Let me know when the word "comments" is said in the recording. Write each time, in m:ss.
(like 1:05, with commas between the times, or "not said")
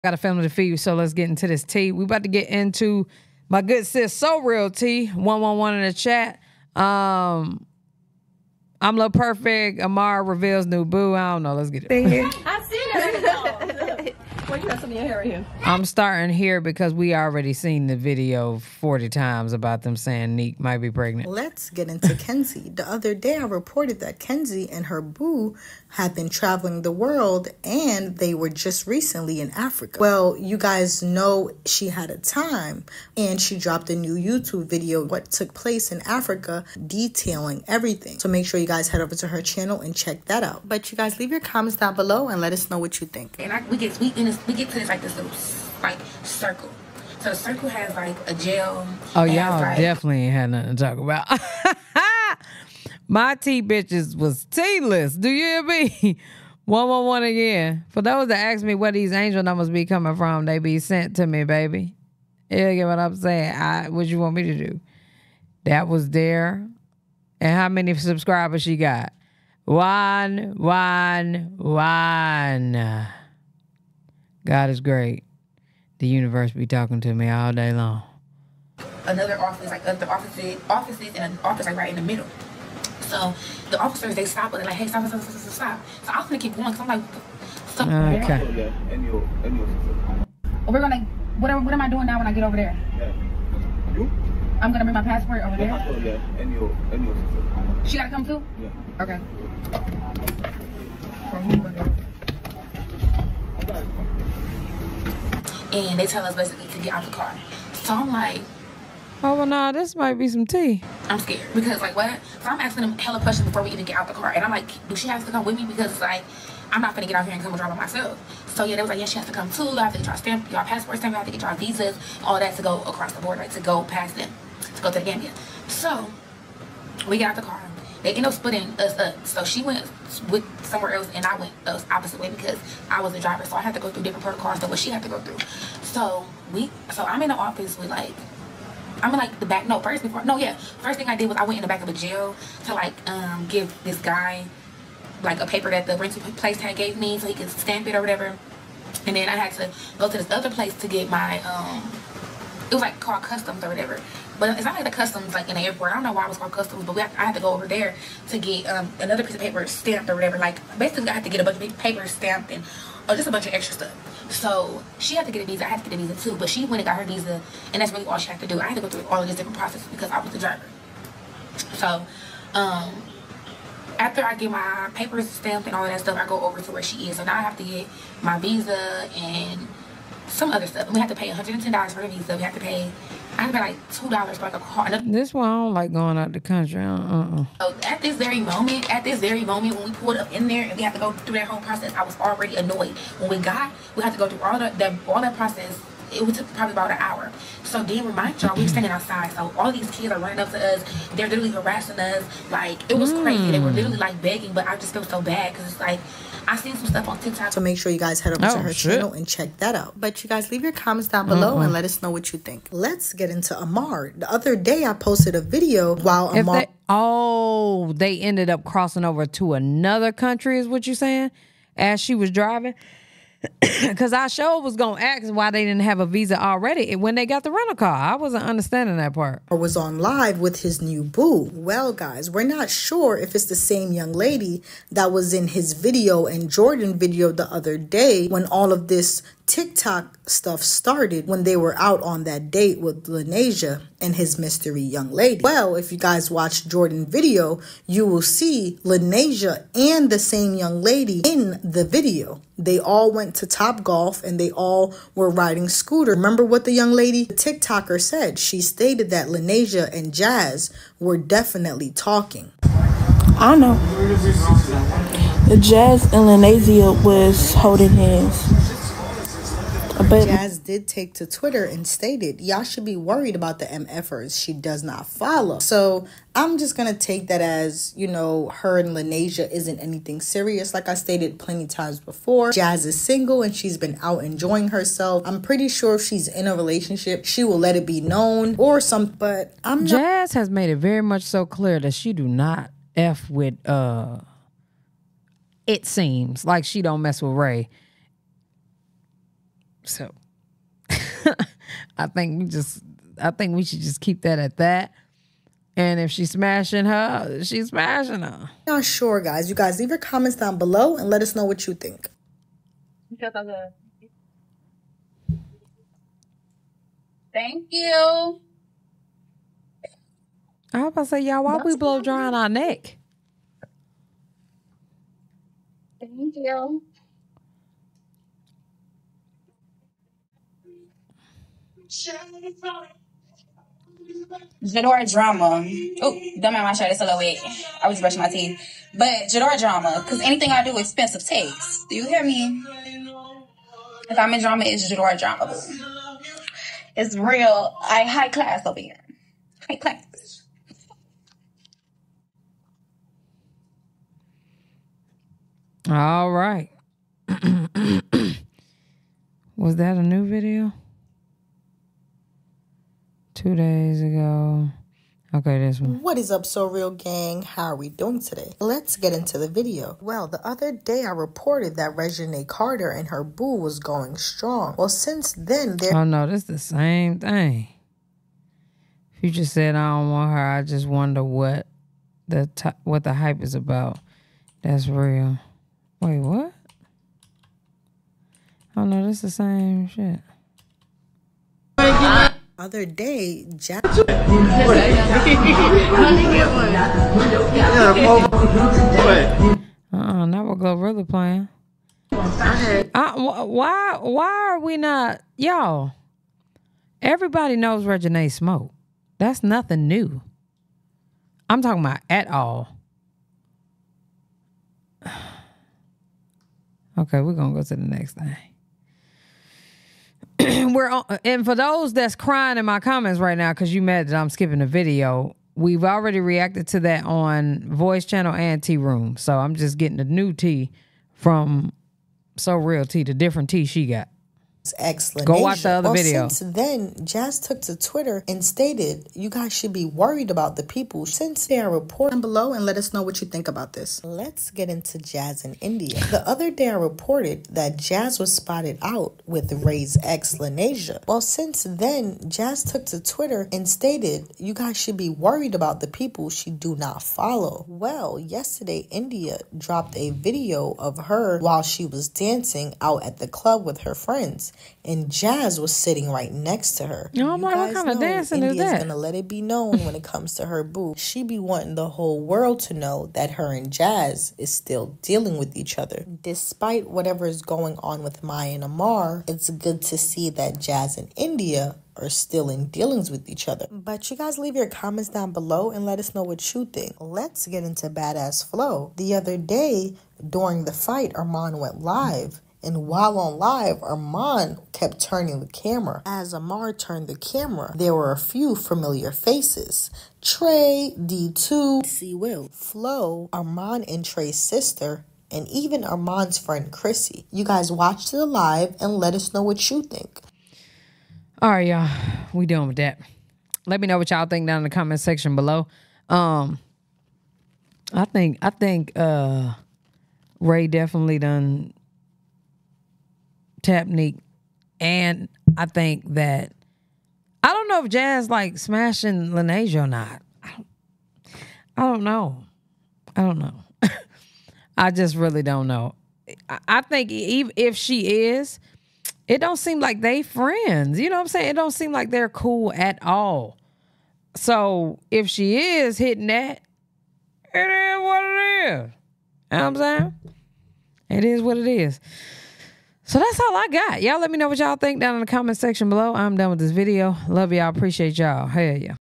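0:41, 3:30, 5:09, 7:02, 8:04, 8:34, 9:15.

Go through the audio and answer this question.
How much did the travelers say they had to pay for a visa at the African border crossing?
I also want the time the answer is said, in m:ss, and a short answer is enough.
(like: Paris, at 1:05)
$110, at 3:01.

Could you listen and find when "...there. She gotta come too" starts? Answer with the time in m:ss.
1:35.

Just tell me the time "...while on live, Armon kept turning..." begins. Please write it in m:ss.
8:12.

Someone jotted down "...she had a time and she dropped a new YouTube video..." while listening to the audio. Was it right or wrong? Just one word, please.
right.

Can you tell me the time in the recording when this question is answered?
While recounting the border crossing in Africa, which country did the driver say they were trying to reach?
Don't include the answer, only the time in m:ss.
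2:04.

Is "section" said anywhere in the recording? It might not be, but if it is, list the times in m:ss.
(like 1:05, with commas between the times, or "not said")
8:34, 9:15.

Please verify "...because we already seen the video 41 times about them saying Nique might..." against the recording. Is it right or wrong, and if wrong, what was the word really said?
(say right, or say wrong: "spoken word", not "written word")
wrong: "40", not "41".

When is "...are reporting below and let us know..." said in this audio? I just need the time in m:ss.
7:21.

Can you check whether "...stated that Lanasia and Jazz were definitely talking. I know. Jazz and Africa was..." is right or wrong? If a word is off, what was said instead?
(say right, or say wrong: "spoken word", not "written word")
wrong: "Lanasia", not "Africa".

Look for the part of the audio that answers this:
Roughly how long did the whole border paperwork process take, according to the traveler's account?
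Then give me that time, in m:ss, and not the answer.
3:16.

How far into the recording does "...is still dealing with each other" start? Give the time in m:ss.
7:54.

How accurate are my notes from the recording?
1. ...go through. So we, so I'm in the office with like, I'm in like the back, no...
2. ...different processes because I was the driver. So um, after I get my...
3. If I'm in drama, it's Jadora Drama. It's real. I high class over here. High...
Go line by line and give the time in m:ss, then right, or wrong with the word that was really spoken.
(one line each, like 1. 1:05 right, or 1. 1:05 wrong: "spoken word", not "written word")
1. 2:15 right
2. 2:49 right
3. 5:44 right.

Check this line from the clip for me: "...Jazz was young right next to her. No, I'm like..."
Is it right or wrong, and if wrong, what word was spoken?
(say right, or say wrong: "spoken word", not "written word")
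wrong: "sitting", not "young".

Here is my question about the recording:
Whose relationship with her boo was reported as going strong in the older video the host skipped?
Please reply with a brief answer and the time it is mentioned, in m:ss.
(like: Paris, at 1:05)
Reginae Carter, at 6:11.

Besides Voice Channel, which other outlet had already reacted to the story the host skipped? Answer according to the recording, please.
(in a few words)
Tea Room.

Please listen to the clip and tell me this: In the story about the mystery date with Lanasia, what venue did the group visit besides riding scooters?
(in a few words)
Top Golf.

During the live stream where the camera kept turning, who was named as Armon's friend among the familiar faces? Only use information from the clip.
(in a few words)
Chrissy.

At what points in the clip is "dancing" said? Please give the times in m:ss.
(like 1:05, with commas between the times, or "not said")
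7:42, 7:47.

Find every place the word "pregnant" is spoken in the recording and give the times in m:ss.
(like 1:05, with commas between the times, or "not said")
0:20.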